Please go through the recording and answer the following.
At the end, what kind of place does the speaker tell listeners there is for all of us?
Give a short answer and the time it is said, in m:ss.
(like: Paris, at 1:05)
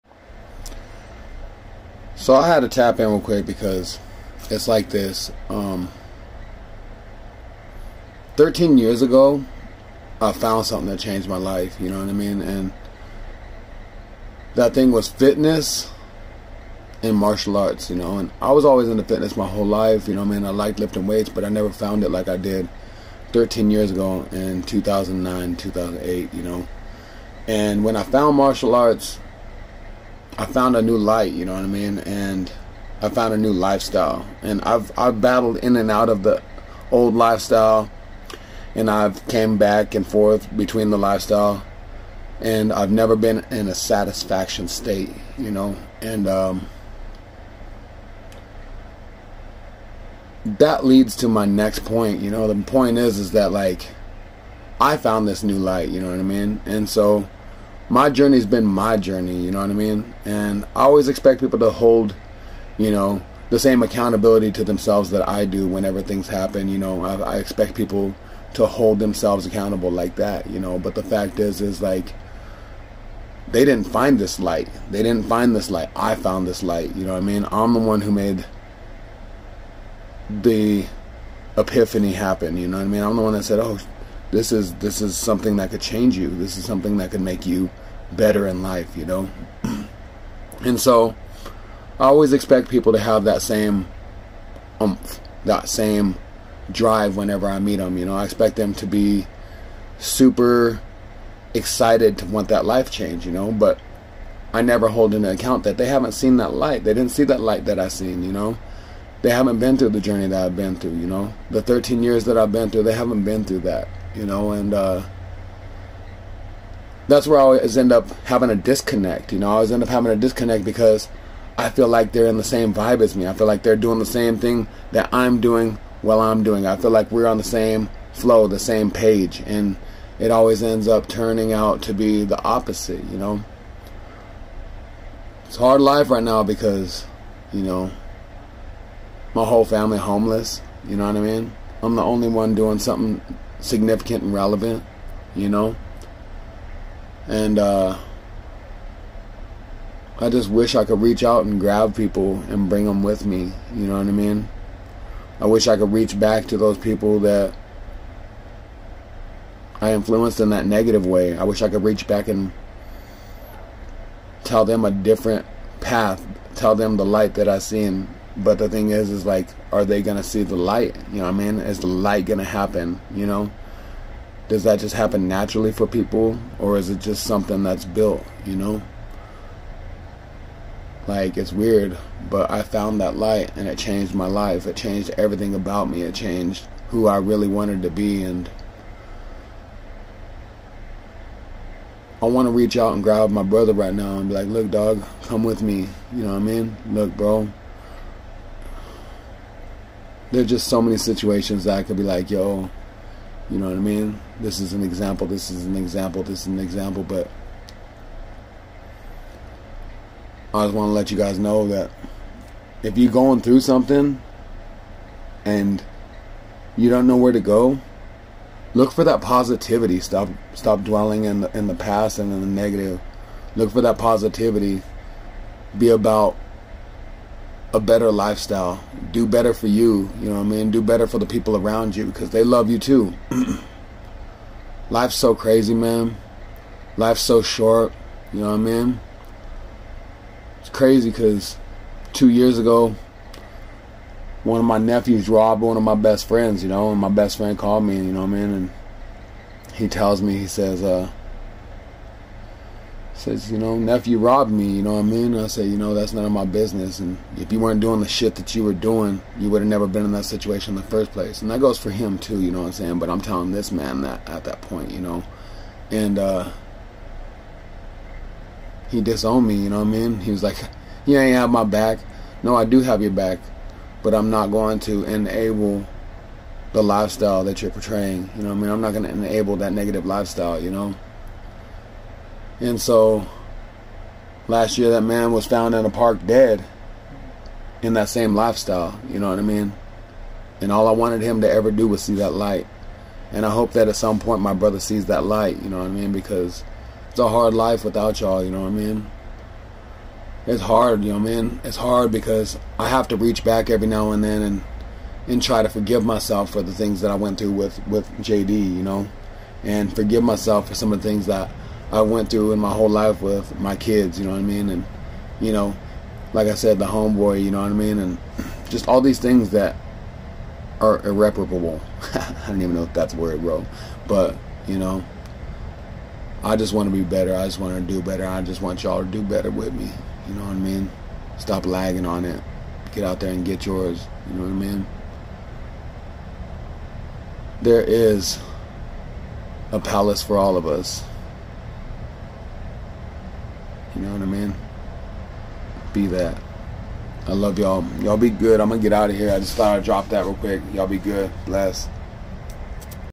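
a palace, at 5:39.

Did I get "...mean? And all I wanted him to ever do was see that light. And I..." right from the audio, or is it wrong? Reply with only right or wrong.
right.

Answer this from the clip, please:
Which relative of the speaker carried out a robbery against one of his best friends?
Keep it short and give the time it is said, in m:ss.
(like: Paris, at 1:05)
nephew, at 4:04.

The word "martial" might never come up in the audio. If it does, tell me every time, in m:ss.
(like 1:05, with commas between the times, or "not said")
0:17, 0:28.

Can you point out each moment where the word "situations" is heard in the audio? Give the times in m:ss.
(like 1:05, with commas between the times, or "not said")
3:20, 4:20.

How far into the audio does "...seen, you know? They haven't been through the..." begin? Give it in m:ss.
1:47.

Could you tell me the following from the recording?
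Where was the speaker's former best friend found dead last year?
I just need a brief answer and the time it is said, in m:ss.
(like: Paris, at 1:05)
in a park, at 4:45.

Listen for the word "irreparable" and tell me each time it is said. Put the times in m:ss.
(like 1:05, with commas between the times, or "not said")
5:21.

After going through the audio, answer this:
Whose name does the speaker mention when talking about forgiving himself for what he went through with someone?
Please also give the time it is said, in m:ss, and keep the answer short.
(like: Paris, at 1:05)
JD, at 5:08.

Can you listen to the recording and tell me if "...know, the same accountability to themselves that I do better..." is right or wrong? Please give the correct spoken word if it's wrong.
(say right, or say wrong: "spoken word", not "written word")
wrong: "whenever", not "better".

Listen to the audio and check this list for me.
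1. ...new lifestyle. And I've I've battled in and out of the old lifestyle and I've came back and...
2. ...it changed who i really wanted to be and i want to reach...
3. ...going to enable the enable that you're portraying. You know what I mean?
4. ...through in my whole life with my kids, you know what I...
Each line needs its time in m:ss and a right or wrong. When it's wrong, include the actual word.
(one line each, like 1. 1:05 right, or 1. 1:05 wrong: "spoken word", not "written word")
1. 0:33 right
2. 3:06 right
3. 4:34 wrong: "lifestyle", not "enable"
4. 5:12 right.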